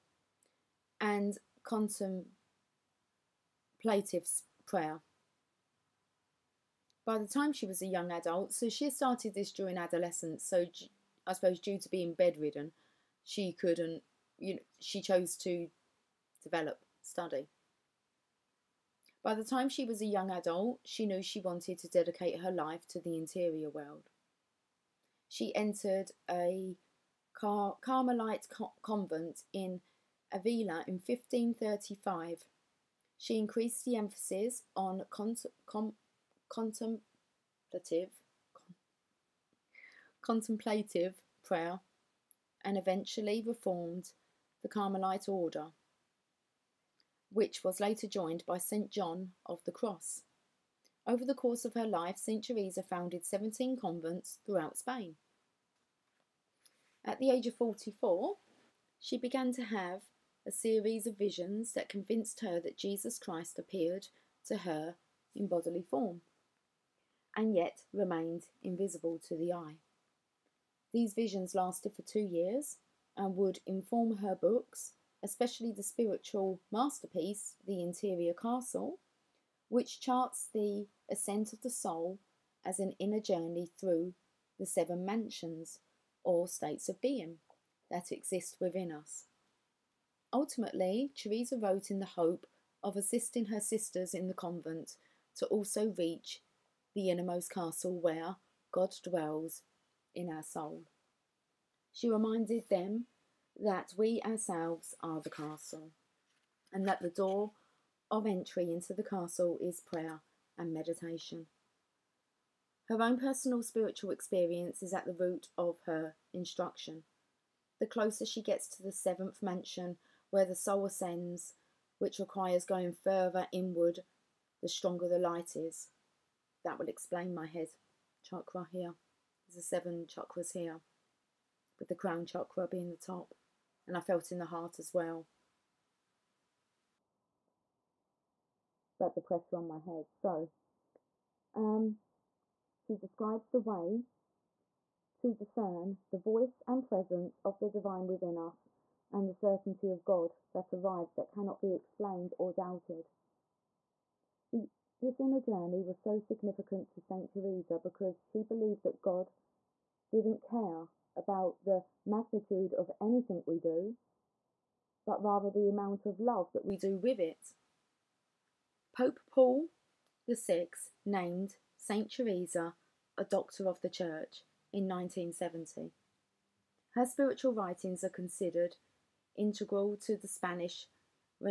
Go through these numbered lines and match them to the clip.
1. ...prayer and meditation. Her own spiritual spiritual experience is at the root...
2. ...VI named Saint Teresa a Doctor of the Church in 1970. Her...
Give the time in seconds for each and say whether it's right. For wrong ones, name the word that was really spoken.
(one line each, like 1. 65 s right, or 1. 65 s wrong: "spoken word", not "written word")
1. 109 s wrong: "personal", not "spiritual"
2. 170 s right.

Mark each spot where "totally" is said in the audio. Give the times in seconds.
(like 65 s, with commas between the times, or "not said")
not said.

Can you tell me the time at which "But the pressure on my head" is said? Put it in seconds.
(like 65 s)
138 s.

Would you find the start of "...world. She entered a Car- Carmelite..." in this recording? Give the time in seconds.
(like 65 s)
23 s.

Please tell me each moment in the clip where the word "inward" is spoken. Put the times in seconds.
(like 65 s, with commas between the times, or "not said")
123 s.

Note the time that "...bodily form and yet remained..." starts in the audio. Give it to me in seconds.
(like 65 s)
65 s.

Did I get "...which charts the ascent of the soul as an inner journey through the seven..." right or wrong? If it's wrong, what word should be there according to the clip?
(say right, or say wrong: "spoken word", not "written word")
right.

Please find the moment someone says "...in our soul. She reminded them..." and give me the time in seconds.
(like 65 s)
100 s.